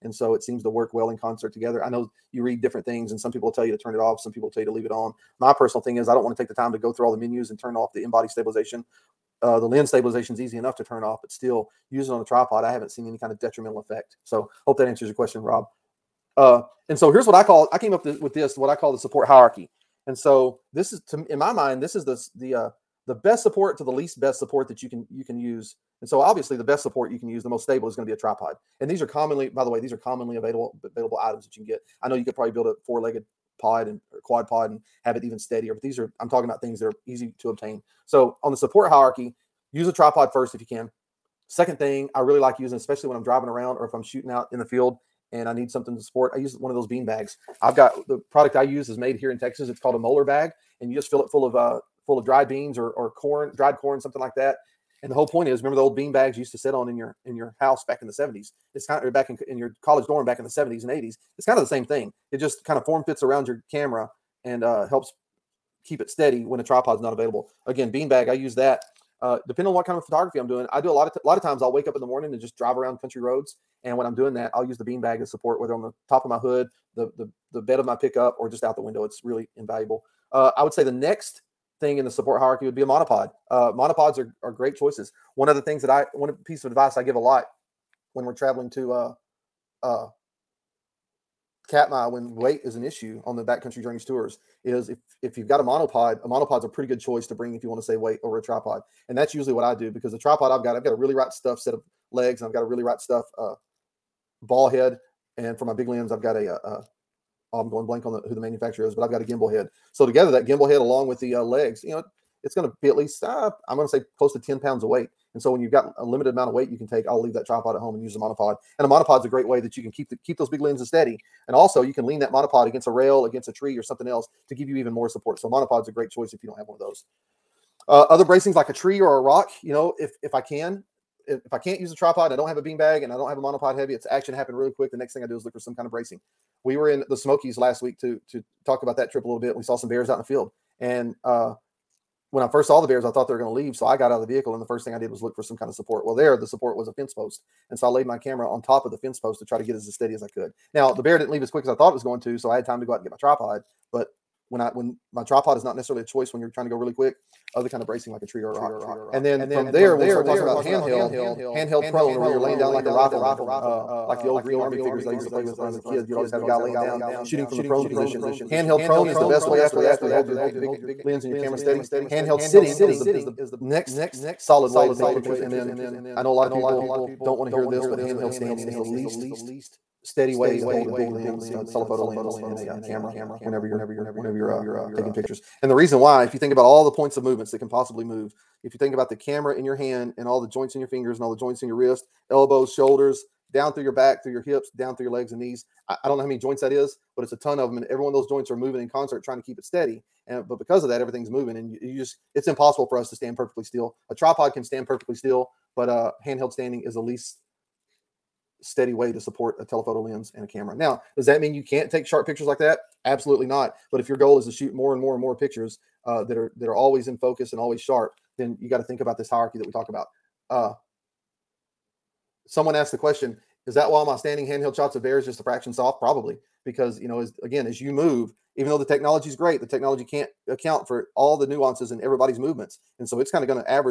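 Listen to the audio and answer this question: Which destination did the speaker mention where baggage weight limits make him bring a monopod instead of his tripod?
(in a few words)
Katmai.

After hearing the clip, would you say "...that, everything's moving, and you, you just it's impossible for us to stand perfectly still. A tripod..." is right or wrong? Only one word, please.
right.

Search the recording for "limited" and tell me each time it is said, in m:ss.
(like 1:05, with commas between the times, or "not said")
1:56.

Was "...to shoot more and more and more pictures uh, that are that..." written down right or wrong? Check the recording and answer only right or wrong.
right.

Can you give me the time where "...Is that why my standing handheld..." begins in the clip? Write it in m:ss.
3:43.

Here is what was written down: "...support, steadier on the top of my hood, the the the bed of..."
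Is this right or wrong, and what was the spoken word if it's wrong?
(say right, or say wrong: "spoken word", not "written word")
wrong: "whether", not "steadier".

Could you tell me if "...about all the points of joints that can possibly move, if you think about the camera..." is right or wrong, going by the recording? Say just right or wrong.
wrong.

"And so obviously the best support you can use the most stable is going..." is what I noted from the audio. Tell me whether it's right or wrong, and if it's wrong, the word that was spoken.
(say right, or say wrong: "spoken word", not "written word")
right.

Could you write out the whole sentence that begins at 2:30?
Now, the bear didn't leave as quick as I thought it was going to.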